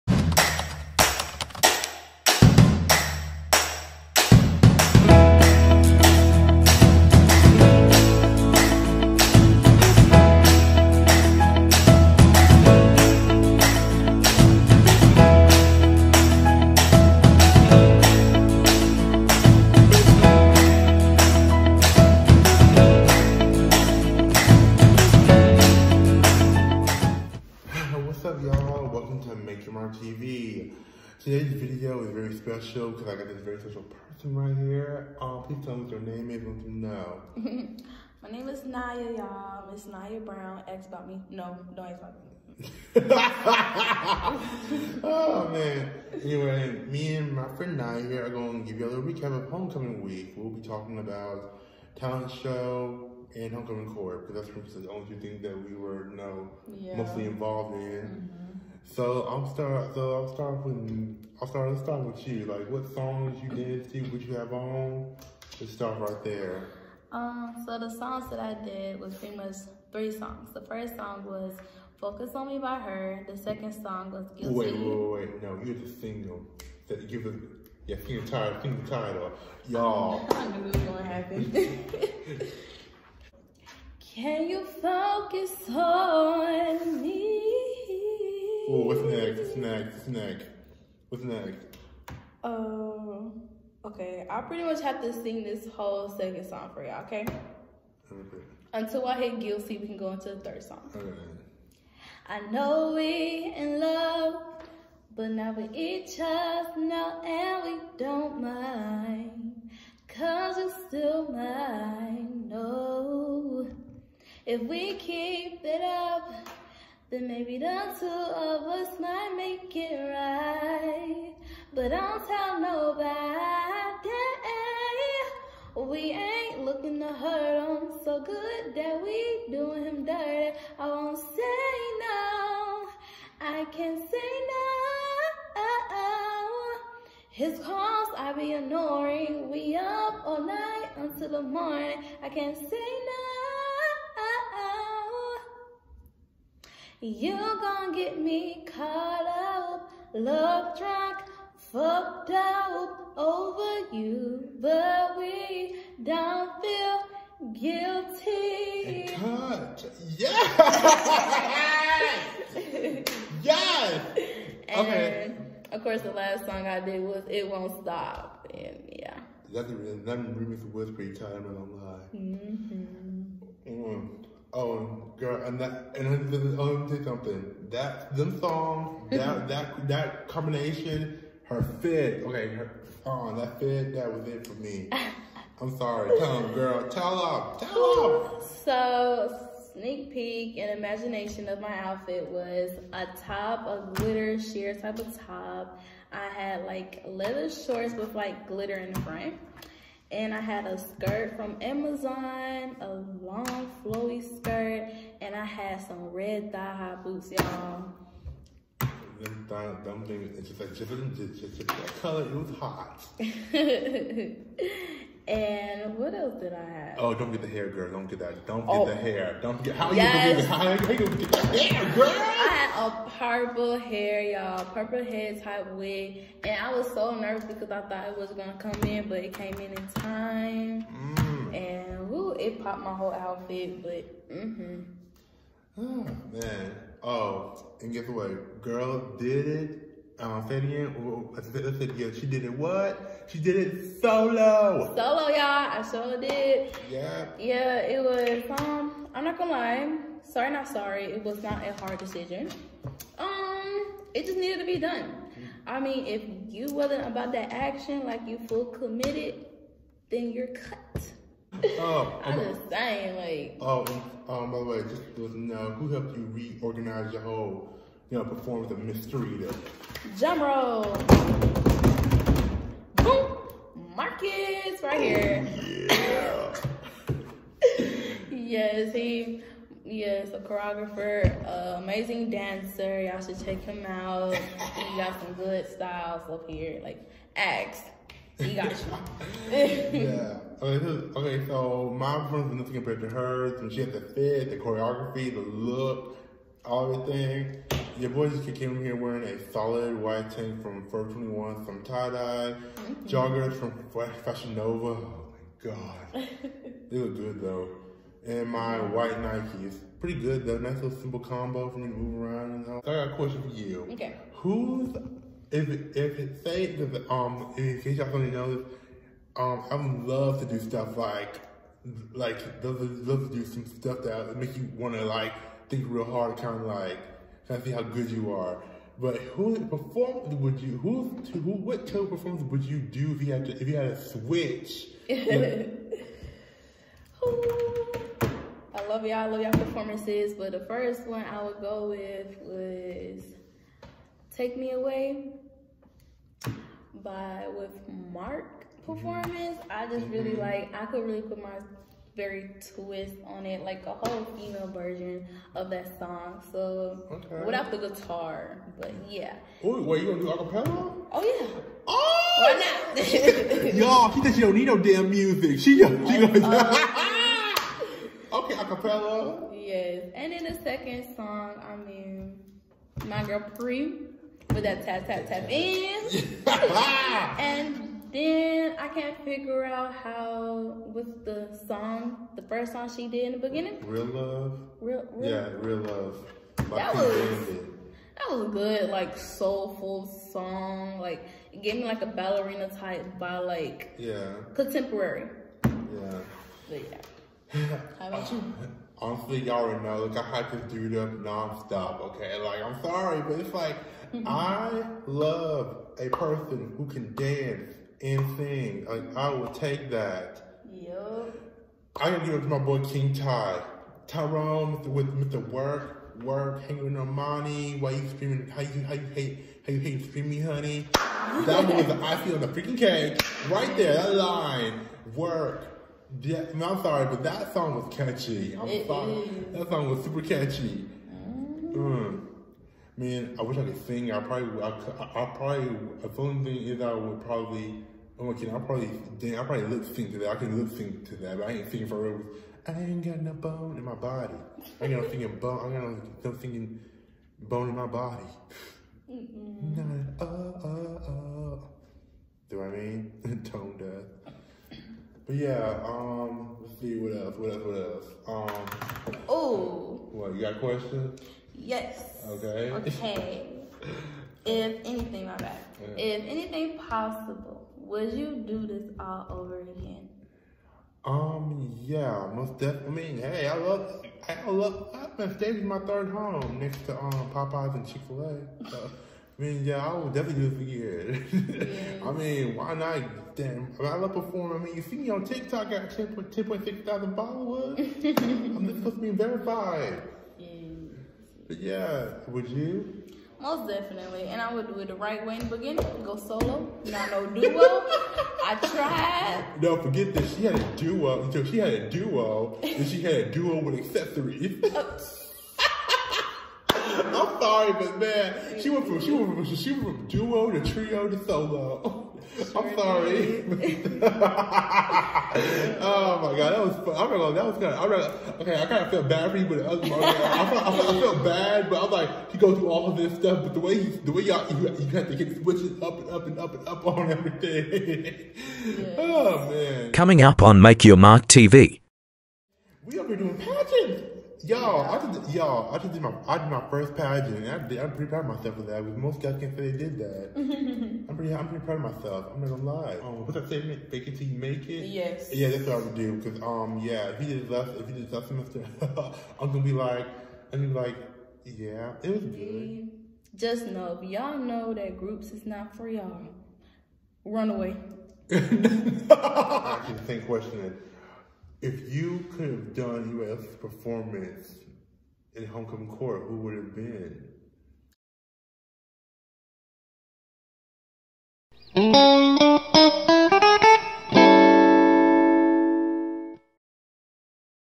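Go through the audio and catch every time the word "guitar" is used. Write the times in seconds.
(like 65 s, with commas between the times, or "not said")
357 s.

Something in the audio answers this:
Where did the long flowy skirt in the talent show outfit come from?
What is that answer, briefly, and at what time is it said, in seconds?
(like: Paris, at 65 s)
Amazon, at 200 s.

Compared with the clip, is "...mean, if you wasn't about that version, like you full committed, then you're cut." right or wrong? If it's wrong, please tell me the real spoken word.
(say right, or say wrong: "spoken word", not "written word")
wrong: "action", not "version".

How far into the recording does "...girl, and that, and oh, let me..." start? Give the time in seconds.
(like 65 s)
175 s.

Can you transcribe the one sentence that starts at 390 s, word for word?
Like it gave me like a ballerina type by like yeah contemporary.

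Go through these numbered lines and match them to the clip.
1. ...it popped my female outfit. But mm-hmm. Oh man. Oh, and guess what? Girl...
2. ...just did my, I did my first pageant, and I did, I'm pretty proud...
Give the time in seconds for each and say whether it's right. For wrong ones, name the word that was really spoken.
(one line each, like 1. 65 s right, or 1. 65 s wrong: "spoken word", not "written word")
1. 232 s wrong: "whole", not "female"
2. 535 s right.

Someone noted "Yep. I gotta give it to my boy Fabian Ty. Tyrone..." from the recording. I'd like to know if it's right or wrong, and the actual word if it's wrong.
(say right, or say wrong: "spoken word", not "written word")
wrong: "King", not "Fabian".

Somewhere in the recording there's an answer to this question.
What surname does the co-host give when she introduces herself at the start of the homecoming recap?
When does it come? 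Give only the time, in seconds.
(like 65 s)
39 s.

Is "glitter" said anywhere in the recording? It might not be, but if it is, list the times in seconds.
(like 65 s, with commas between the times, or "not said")
193 s, 198 s.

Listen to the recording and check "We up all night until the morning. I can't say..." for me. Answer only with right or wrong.
right.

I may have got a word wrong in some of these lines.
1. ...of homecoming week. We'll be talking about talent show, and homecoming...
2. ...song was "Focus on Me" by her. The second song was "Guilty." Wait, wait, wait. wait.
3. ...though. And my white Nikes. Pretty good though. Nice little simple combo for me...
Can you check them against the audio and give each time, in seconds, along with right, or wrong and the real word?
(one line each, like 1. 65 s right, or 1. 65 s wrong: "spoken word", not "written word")
1. 49 s right
2. 70 s right
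3. 307 s right.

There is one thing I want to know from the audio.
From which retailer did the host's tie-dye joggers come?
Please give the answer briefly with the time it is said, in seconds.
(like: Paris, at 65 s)
Fashion Nova, at 304 s.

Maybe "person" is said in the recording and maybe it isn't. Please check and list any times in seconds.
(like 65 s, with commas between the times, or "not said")
33 s, 406 s.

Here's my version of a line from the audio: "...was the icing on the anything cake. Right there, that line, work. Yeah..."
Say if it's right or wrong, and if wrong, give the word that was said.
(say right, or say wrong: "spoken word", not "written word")
wrong: "freaking", not "anything".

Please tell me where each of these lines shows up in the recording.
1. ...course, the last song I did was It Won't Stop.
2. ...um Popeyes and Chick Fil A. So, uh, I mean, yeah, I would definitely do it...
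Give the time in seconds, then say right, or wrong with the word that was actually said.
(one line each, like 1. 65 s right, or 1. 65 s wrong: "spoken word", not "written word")
1. 165 s right
2. 476 s right.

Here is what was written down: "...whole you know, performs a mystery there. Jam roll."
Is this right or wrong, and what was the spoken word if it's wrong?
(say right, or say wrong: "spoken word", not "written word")
right.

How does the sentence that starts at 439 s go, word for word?
I probably lip sync to that.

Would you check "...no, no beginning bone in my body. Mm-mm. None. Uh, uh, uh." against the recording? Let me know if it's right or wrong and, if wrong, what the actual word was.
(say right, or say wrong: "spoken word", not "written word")
wrong: "thinking", not "beginning".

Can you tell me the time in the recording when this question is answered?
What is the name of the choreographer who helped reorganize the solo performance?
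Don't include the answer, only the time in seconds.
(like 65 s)
273 s.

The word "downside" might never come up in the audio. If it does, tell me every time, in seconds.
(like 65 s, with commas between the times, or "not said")
not said.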